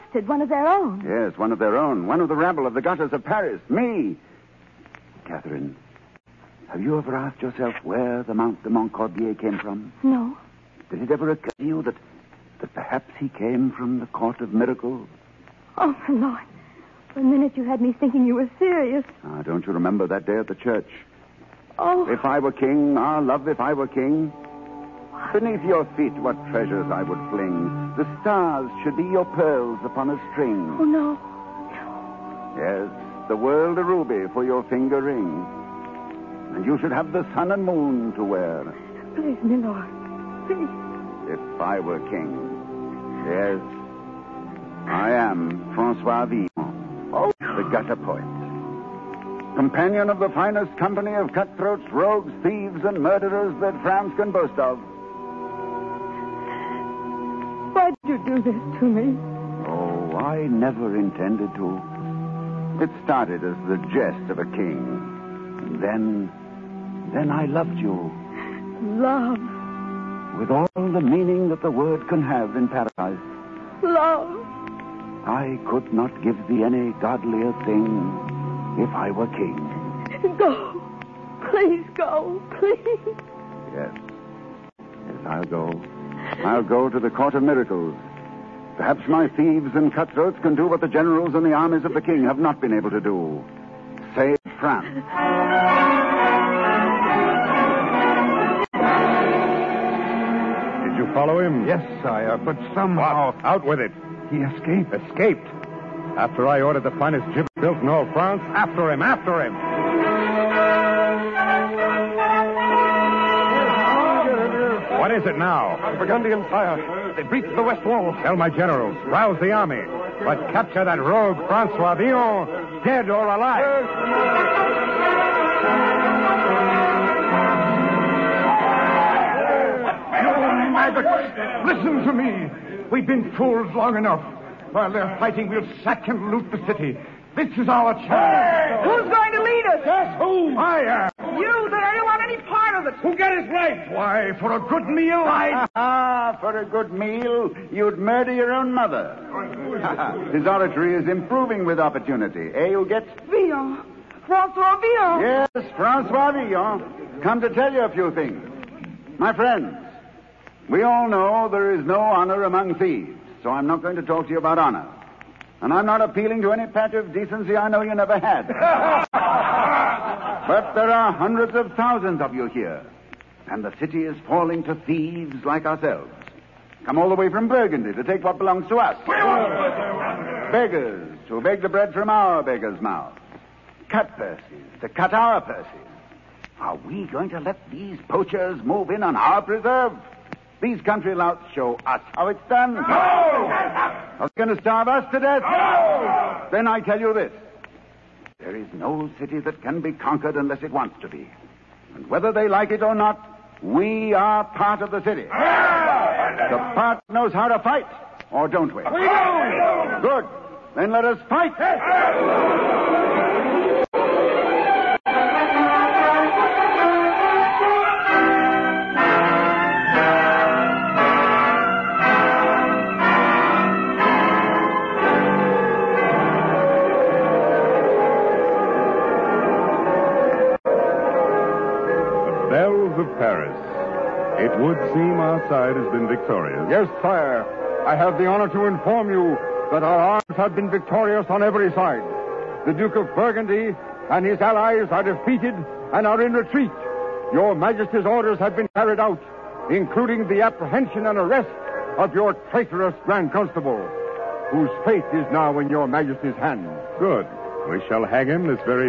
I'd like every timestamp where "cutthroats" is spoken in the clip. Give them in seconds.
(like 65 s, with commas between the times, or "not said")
51 s, 89 s.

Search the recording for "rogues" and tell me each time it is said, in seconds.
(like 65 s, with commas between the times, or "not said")
51 s, 120 s.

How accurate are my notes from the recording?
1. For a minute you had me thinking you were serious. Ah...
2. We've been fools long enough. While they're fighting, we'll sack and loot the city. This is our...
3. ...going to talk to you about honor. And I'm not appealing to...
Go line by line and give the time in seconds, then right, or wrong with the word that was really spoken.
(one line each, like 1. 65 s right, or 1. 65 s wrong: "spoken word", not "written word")
1. 17 s right
2. 132 s right
3. 163 s right.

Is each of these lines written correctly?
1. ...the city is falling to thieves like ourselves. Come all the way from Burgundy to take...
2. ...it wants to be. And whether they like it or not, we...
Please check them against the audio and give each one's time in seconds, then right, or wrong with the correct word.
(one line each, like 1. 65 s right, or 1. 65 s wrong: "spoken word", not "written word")
1. 173 s right
2. 200 s right.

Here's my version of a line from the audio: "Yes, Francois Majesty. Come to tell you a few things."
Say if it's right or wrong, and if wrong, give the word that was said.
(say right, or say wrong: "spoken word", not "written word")
wrong: "Villon", not "Majesty".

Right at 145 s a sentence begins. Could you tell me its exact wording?
Ah, for a good meal, you'd murder your own mother.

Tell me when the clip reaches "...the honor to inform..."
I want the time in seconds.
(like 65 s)
238 s.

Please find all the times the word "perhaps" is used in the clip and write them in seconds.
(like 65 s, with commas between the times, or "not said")
12 s, 88 s.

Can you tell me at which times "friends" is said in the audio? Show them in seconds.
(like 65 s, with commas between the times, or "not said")
159 s.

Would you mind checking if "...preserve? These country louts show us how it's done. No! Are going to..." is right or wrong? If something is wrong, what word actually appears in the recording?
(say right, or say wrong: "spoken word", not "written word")
right.